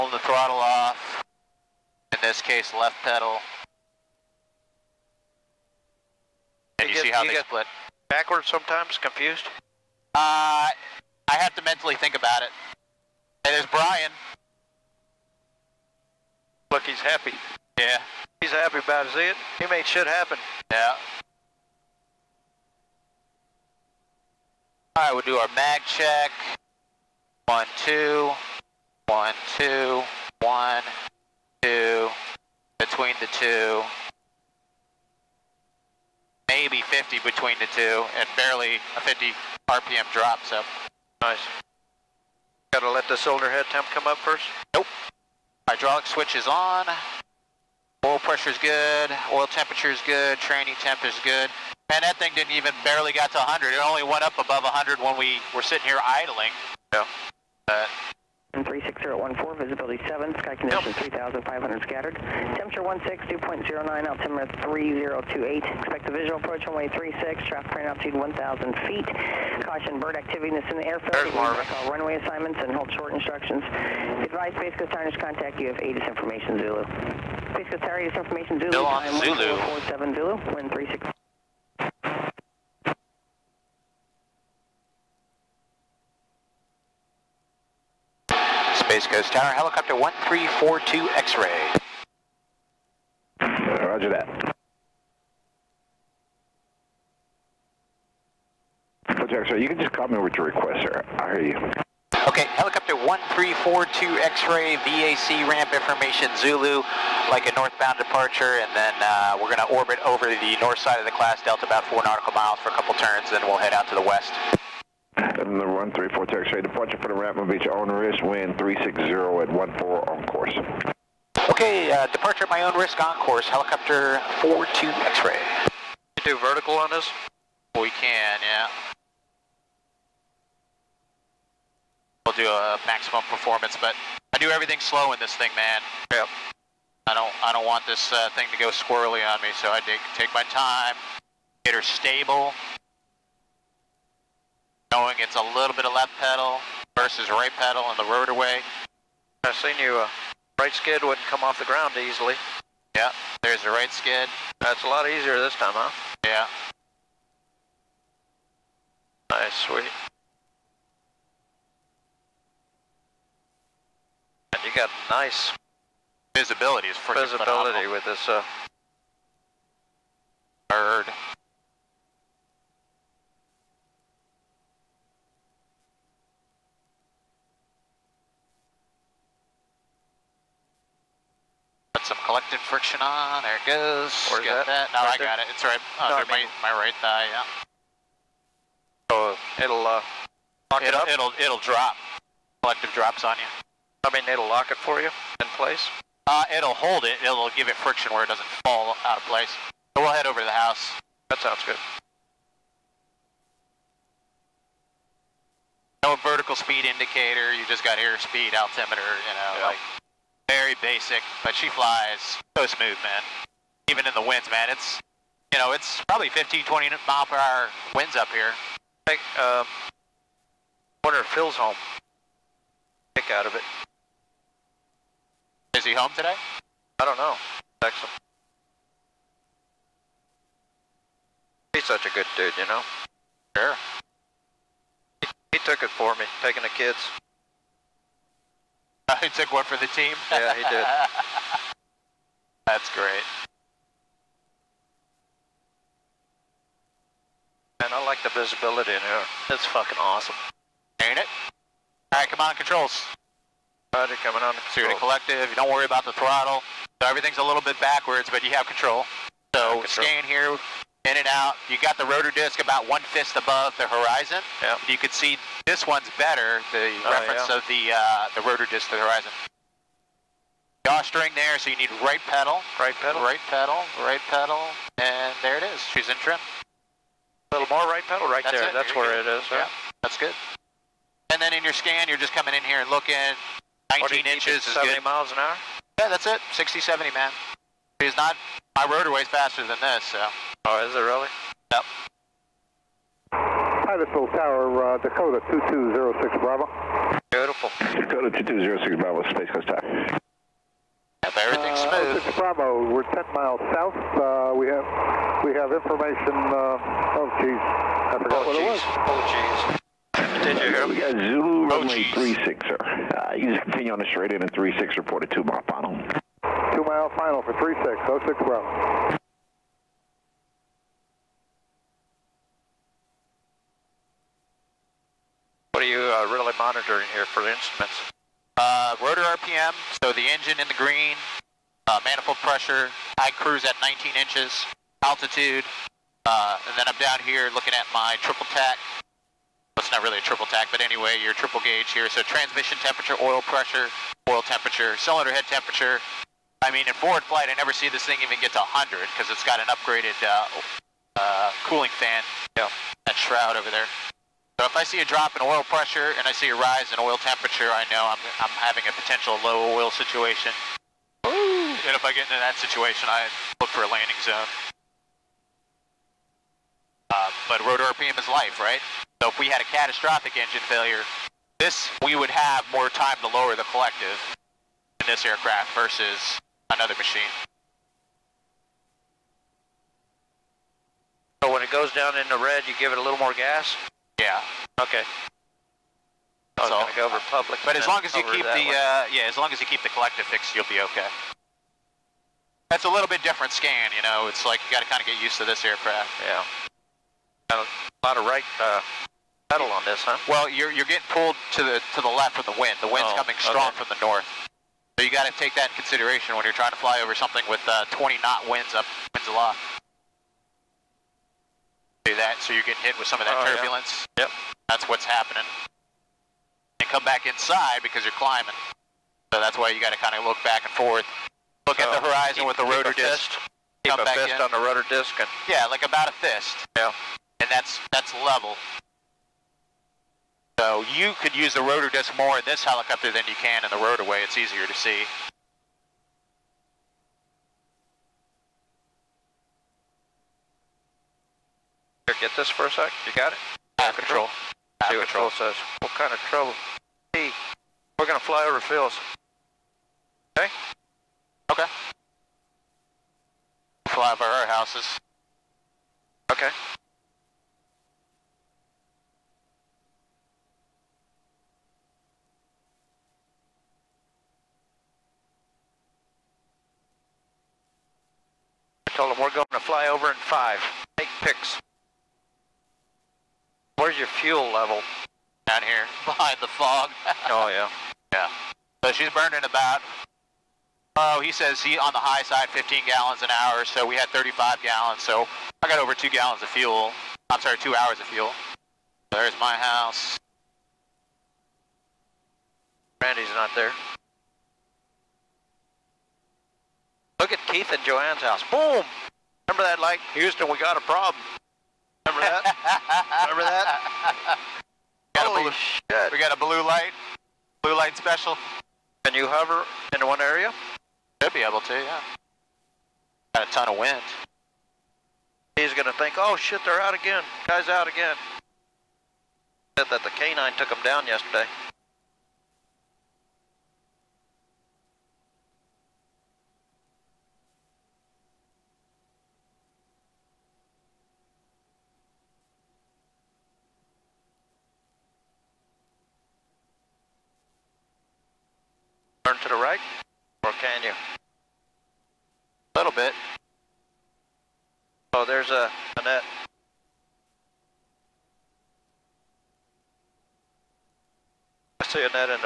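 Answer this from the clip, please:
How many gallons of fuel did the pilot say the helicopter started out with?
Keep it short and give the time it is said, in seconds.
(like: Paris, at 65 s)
35, at 484 s.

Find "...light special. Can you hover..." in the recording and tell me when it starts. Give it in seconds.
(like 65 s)
507 s.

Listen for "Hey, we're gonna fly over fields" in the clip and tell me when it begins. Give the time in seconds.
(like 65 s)
447 s.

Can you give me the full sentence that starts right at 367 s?
Uh, but rotor RPM is life, right?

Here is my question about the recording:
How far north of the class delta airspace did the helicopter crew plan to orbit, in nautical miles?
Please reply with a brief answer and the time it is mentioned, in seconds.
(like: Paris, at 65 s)
4, at 111 s.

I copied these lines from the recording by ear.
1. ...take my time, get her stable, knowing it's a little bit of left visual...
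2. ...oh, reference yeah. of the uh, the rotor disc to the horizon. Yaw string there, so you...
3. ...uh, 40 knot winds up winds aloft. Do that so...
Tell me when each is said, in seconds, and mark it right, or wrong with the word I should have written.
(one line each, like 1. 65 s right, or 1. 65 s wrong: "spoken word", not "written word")
1. 140 s wrong: "pedal", not "visual"
2. 267 s right
3. 407 s wrong: "20", not "40".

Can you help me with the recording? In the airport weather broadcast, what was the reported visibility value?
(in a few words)
7.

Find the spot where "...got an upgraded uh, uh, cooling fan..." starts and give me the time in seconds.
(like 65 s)
349 s.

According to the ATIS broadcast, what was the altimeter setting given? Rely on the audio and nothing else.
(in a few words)
3028.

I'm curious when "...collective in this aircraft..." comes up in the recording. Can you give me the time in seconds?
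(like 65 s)
373 s.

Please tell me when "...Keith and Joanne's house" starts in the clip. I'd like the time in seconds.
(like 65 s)
497 s.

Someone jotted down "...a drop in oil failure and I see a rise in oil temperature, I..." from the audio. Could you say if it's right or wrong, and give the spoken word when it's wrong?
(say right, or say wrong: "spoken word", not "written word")
wrong: "pressure", not "failure".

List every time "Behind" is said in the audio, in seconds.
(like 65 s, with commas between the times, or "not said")
476 s.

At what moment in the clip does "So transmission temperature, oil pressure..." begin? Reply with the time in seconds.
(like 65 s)
342 s.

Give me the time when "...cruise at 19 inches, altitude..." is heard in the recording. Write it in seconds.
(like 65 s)
333 s.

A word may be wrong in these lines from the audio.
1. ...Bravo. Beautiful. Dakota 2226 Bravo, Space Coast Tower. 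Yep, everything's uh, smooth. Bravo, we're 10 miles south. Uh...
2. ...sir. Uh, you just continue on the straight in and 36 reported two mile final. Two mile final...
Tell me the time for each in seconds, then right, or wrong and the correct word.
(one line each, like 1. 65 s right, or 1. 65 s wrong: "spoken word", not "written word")
1. 296 s wrong: "2206", not "2226"
2. 312 s right.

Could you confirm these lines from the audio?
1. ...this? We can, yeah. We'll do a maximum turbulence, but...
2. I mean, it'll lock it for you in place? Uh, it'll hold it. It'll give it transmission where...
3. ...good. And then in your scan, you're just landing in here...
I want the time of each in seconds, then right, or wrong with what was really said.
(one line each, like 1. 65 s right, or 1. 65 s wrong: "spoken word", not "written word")
1. 126 s wrong: "performance", not "turbulence"
2. 194 s wrong: "friction", not "transmission"
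3. 280 s wrong: "coming", not "landing".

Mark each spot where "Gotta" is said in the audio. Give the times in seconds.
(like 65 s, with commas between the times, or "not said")
42 s.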